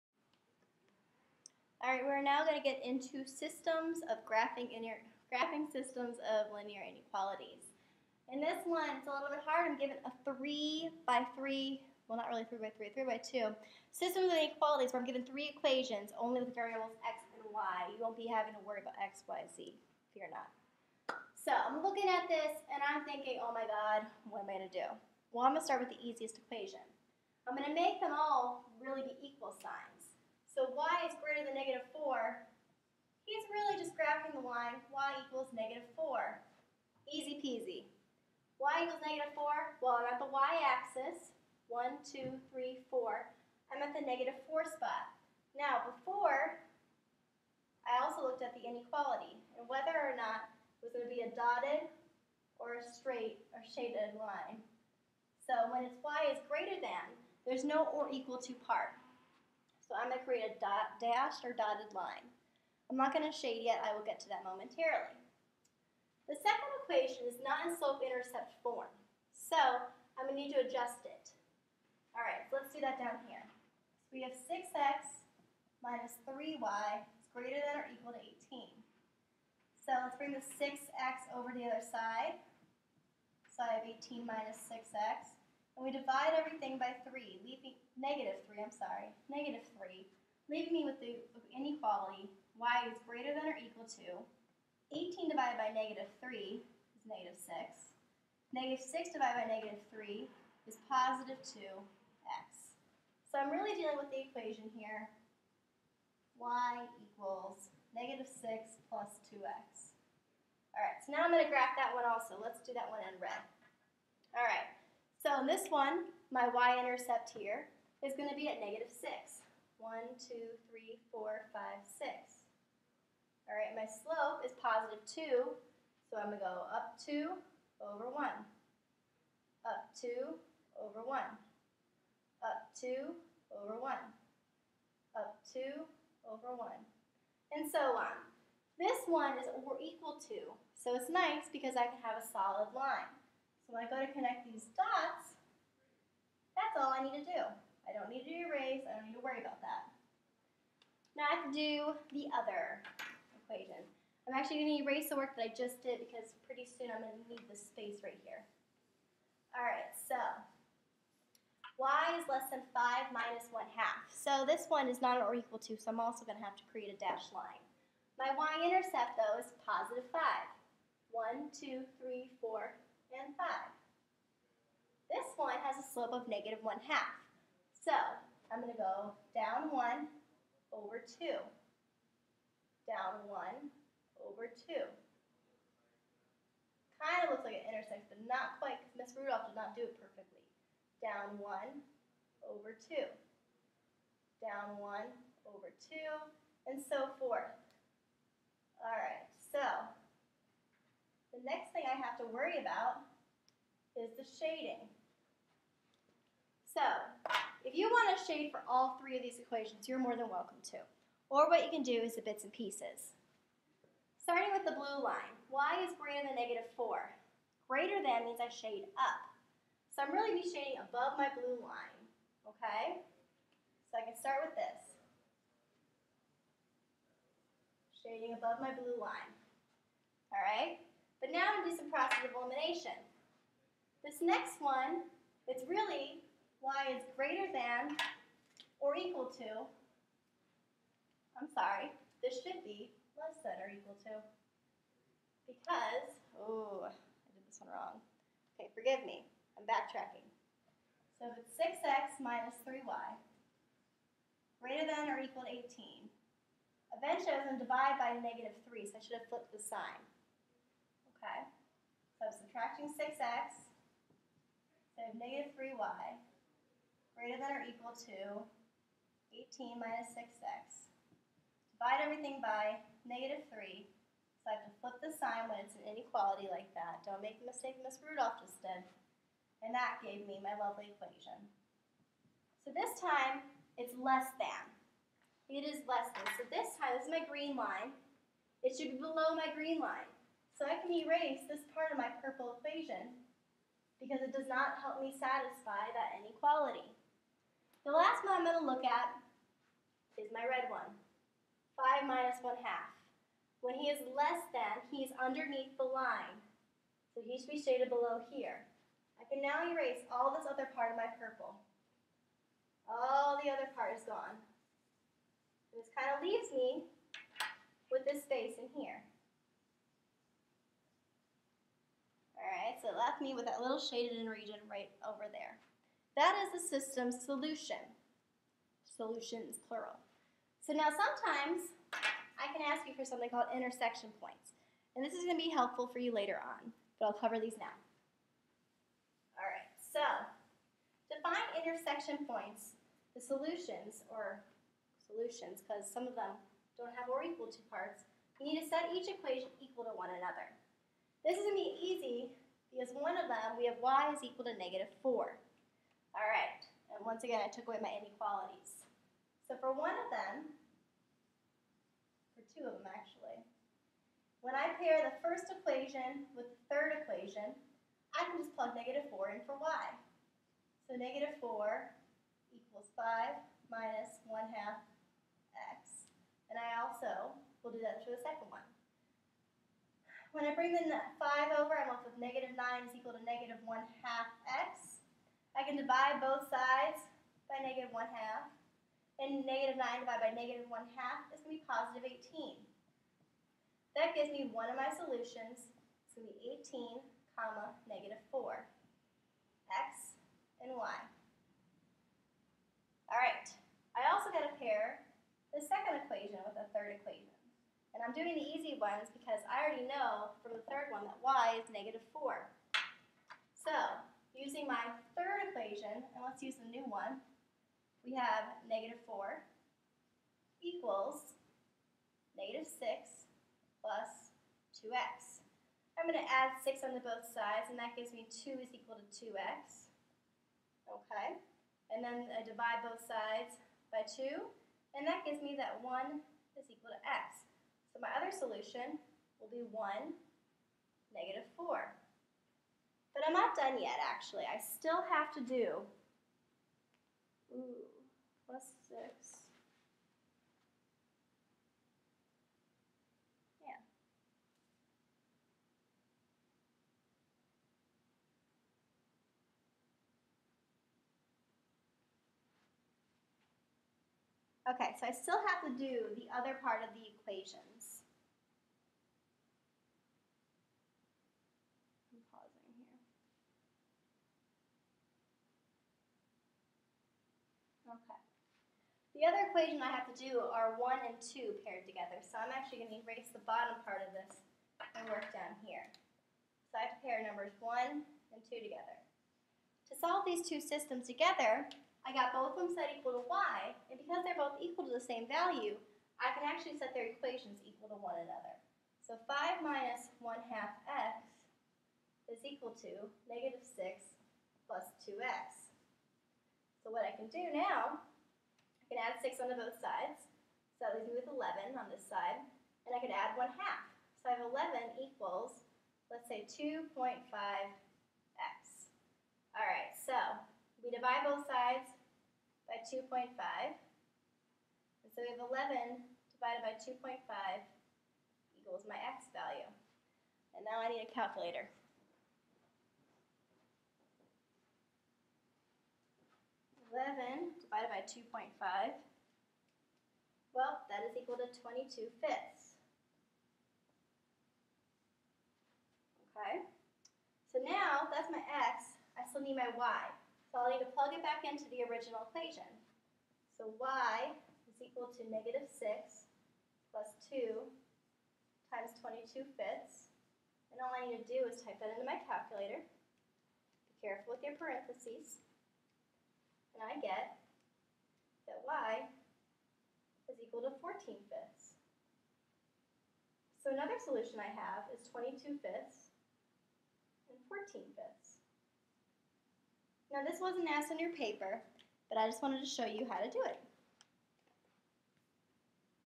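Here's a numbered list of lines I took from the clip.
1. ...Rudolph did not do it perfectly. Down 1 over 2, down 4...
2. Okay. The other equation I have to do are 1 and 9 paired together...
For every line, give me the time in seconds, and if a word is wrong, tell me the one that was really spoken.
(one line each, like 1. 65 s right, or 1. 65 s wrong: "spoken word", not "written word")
1. 189 s wrong: "1", not "4"
2. 477 s wrong: "2", not "9".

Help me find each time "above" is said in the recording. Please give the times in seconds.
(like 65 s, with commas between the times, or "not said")
220 s, 228 s.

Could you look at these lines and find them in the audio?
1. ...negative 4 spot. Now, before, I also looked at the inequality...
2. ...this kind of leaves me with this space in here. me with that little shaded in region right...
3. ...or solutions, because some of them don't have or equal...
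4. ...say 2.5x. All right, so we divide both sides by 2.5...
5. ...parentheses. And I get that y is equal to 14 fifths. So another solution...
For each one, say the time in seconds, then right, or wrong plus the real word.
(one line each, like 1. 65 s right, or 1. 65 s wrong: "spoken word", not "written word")
1. 44 s right
2. 315 s right
3. 344 s right
4. 516 s right
5. 564 s right.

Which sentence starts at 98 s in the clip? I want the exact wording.
Negative 6 divided by negative 3 is positive 2x.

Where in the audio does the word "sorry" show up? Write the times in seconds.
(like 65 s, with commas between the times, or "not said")
88 s, 241 s.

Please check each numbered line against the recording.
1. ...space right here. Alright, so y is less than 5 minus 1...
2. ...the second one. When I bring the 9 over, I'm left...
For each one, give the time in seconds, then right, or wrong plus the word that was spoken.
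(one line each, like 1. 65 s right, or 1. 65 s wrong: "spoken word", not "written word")
1. 157 s right
2. 378 s wrong: "5", not "9".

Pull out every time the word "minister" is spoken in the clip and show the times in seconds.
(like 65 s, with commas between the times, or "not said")
not said.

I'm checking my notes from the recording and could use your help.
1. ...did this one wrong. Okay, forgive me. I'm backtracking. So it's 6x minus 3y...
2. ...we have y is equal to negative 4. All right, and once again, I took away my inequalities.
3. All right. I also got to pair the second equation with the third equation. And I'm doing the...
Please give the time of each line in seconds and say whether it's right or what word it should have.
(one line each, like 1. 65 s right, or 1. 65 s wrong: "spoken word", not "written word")
1. 247 s right
2. 353 s right
3. 403 s right.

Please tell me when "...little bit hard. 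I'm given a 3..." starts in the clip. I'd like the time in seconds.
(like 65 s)
9 s.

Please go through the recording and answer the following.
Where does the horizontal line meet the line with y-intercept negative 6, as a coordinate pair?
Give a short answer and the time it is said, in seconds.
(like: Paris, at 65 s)
(1, -4), at 439 s.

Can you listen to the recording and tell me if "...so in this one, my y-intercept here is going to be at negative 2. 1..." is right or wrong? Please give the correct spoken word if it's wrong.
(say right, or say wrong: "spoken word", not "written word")
wrong: "6", not "2".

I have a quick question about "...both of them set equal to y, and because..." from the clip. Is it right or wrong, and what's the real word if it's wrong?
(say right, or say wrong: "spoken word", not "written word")
right.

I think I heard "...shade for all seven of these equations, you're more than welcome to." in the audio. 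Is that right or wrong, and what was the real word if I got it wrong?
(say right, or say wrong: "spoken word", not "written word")
wrong: "three", not "seven".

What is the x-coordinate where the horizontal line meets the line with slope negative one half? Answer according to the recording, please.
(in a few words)
18.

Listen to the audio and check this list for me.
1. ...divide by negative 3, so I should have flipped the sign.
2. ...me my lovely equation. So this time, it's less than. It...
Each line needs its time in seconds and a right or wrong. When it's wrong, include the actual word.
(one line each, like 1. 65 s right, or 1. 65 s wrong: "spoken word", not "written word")
1. 257 s right
2. 280 s right.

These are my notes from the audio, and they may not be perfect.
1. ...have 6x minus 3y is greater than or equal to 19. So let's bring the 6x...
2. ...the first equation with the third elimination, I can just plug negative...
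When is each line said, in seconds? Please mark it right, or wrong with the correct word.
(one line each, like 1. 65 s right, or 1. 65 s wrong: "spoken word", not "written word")
1. 74 s wrong: "18", not "19"
2. 365 s wrong: "equation", not "elimination".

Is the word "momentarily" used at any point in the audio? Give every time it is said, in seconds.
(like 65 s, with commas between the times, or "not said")
64 s.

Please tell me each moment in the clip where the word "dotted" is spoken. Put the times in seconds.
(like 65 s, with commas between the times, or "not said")
51 s, 61 s.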